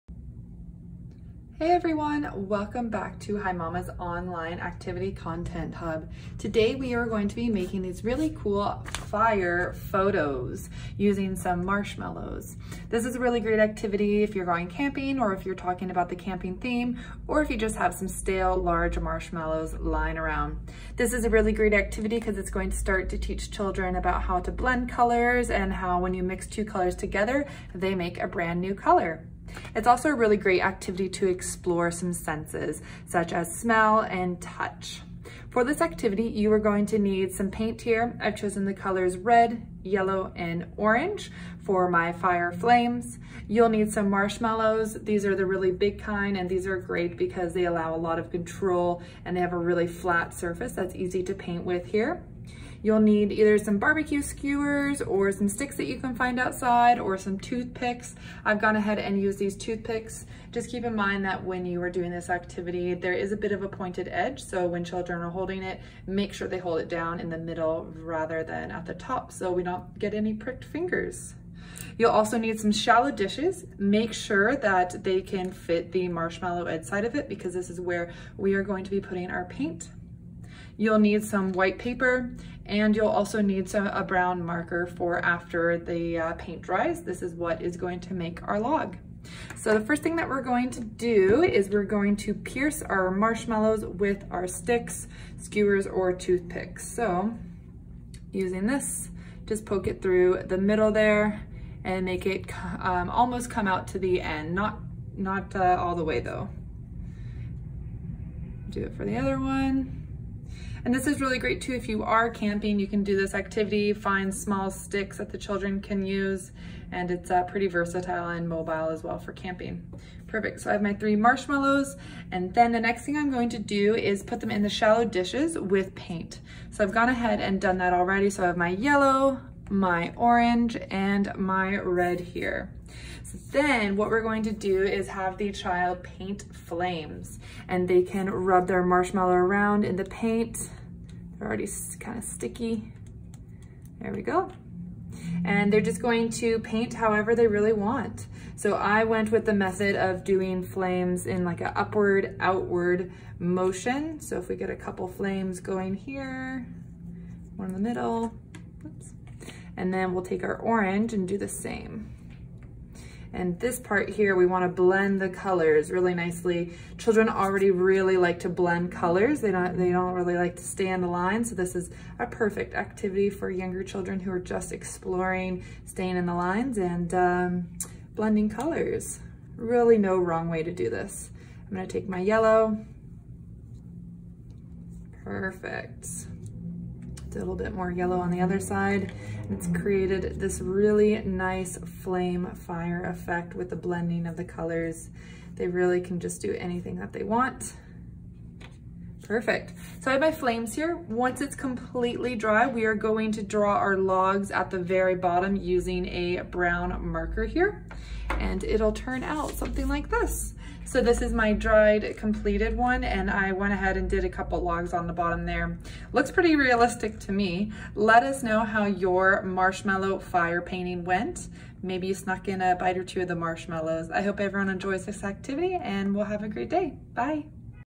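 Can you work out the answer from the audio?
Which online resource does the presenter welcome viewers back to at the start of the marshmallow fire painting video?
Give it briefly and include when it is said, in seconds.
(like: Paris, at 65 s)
HiMama's online activity content hub, at 3 s.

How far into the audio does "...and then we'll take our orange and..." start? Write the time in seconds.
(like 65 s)
159 s.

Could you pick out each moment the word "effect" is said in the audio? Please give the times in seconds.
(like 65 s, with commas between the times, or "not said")
193 s.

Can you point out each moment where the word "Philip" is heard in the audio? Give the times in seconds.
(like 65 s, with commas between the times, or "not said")
not said.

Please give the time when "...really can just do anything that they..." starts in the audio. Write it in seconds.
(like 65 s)
195 s.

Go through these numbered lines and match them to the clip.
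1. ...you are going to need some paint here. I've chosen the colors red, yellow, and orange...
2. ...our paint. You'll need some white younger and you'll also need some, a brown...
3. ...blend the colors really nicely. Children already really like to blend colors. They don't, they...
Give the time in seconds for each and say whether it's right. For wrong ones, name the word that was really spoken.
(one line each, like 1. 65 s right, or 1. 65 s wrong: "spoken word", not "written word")
1. 36 s right
2. 79 s wrong: "paper", not "younger"
3. 164 s right.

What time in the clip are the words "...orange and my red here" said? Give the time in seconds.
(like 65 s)
130 s.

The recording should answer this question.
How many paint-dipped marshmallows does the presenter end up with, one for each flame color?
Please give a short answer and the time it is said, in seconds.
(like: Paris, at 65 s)
3, at 120 s.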